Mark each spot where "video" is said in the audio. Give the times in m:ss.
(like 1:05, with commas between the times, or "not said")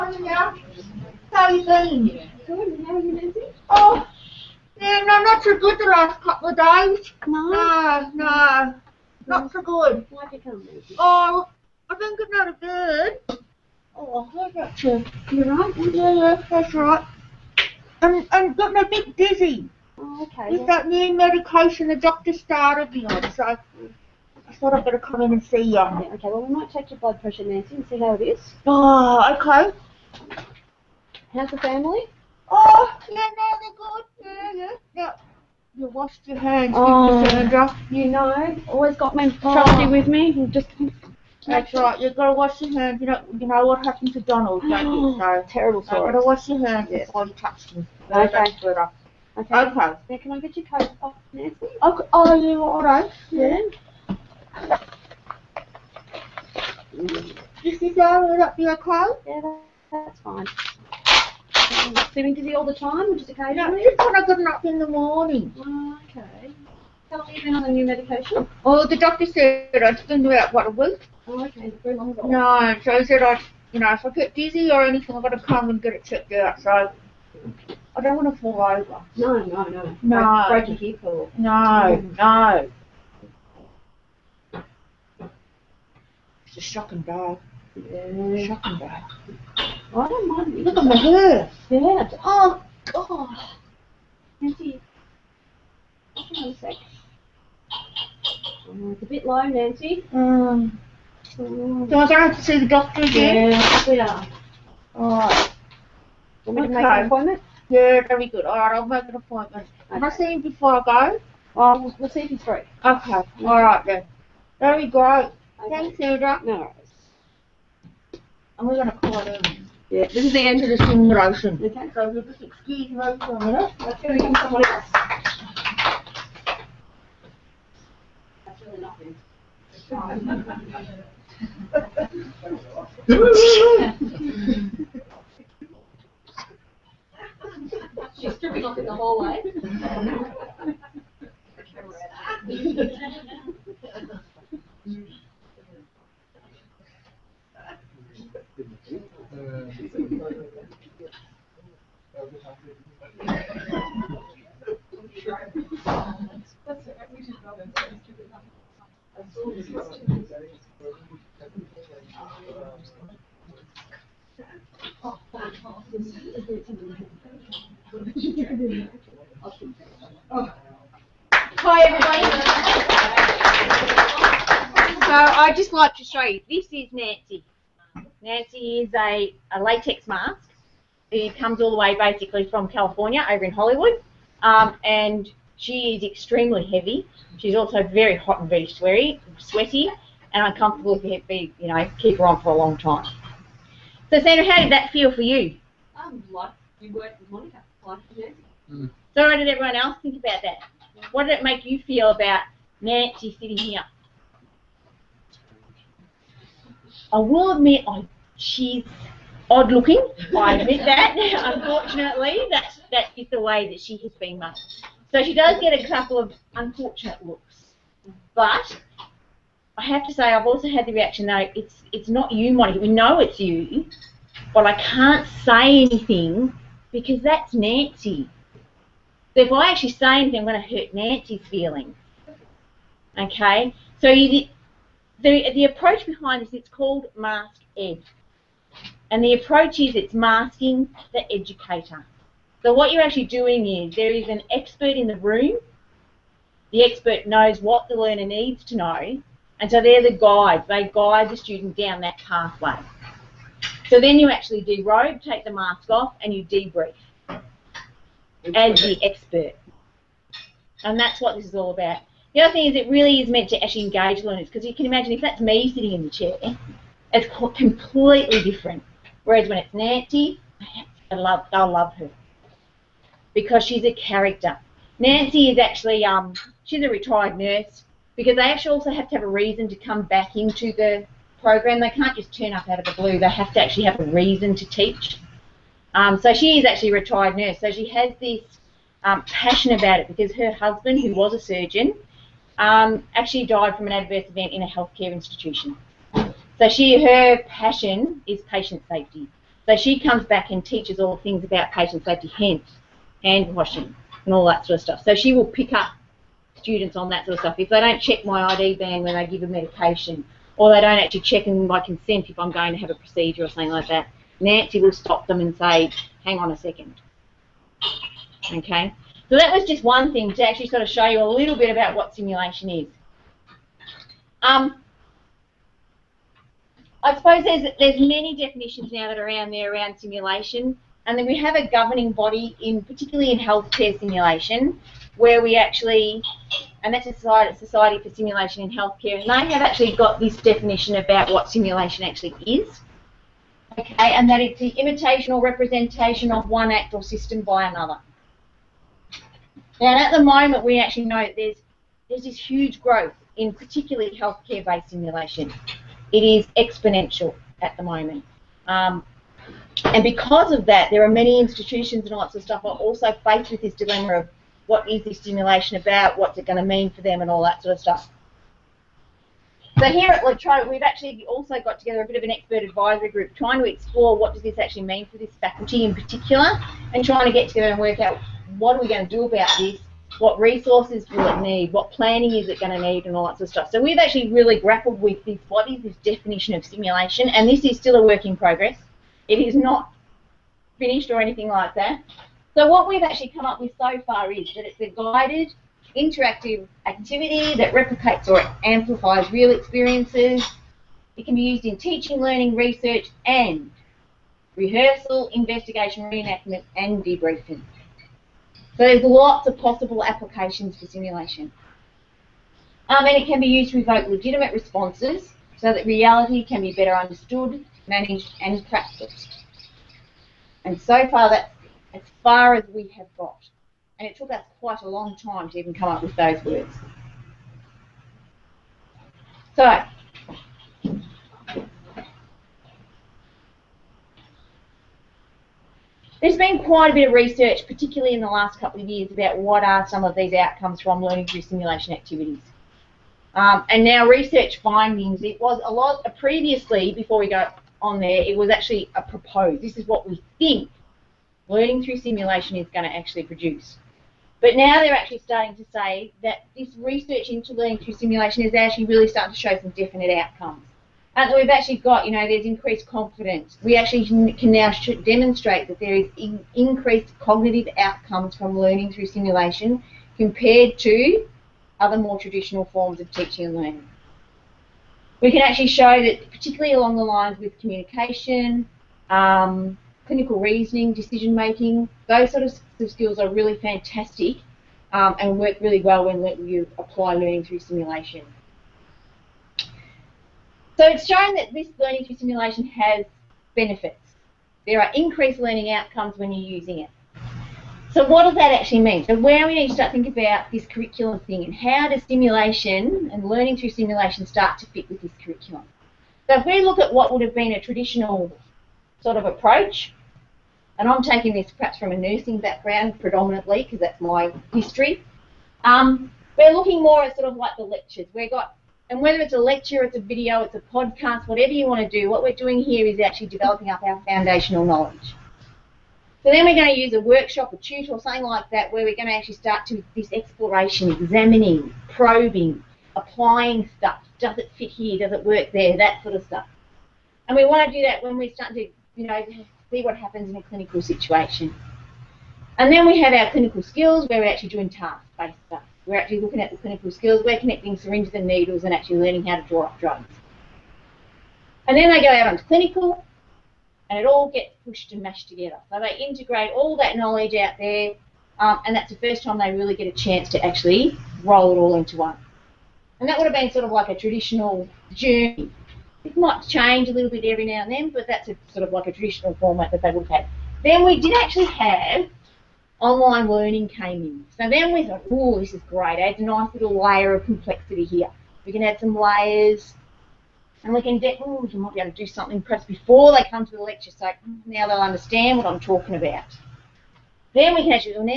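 8:39.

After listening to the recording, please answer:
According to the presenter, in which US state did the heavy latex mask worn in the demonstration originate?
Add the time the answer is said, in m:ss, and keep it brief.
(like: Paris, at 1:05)
California, at 3:02.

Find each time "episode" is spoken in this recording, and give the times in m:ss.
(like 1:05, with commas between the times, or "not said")
not said.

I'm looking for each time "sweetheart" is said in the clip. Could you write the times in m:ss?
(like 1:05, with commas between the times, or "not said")
1:43.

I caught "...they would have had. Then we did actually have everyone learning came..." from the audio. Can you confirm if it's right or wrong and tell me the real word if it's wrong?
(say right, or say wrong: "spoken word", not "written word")
wrong: "online", not "everyone".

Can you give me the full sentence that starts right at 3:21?
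What did it make you feel about Nancy sitting here?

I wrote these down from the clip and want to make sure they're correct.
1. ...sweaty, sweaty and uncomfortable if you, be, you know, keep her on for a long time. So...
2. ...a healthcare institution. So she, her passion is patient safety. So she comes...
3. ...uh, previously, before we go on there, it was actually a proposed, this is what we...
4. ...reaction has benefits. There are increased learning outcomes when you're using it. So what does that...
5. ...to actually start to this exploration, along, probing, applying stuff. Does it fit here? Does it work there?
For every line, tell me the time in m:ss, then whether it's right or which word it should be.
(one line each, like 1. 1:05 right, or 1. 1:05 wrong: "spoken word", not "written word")
1. 3:08 right
2. 4:54 right
3. 7:26 right
4. 8:12 wrong: "simulation", not "reaction"
5. 8:49 wrong: "examining", not "along".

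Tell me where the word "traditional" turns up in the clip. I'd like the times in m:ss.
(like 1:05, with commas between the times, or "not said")
7:52, 8:27, 9:23, 9:28.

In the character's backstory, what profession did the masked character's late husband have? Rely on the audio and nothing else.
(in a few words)
surgeon.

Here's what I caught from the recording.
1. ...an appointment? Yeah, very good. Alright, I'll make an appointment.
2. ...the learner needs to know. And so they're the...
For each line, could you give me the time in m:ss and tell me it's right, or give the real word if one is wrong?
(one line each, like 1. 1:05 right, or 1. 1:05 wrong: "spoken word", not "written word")
1. 1:46 right
2. 4:07 right.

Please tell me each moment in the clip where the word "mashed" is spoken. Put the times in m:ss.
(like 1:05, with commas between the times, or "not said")
9:15.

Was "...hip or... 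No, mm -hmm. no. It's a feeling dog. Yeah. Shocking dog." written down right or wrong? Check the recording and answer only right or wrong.
wrong.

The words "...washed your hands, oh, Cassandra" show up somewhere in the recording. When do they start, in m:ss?
0:35.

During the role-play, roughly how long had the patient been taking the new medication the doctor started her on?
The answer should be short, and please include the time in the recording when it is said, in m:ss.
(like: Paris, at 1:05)
a week, at 1:10.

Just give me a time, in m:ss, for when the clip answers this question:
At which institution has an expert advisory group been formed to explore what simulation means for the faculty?
6:10.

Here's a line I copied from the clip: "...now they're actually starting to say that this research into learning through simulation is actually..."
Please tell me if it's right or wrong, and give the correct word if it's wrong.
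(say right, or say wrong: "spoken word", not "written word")
right.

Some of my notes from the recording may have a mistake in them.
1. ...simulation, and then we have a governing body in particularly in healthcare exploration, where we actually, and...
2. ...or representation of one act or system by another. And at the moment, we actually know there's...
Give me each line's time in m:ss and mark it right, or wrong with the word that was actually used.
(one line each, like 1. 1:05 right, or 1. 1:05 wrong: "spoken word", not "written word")
1. 5:29 wrong: "simulation", not "exploration"
2. 5:45 right.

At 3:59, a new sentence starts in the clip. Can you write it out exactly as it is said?
And the approach is it's masking the educator.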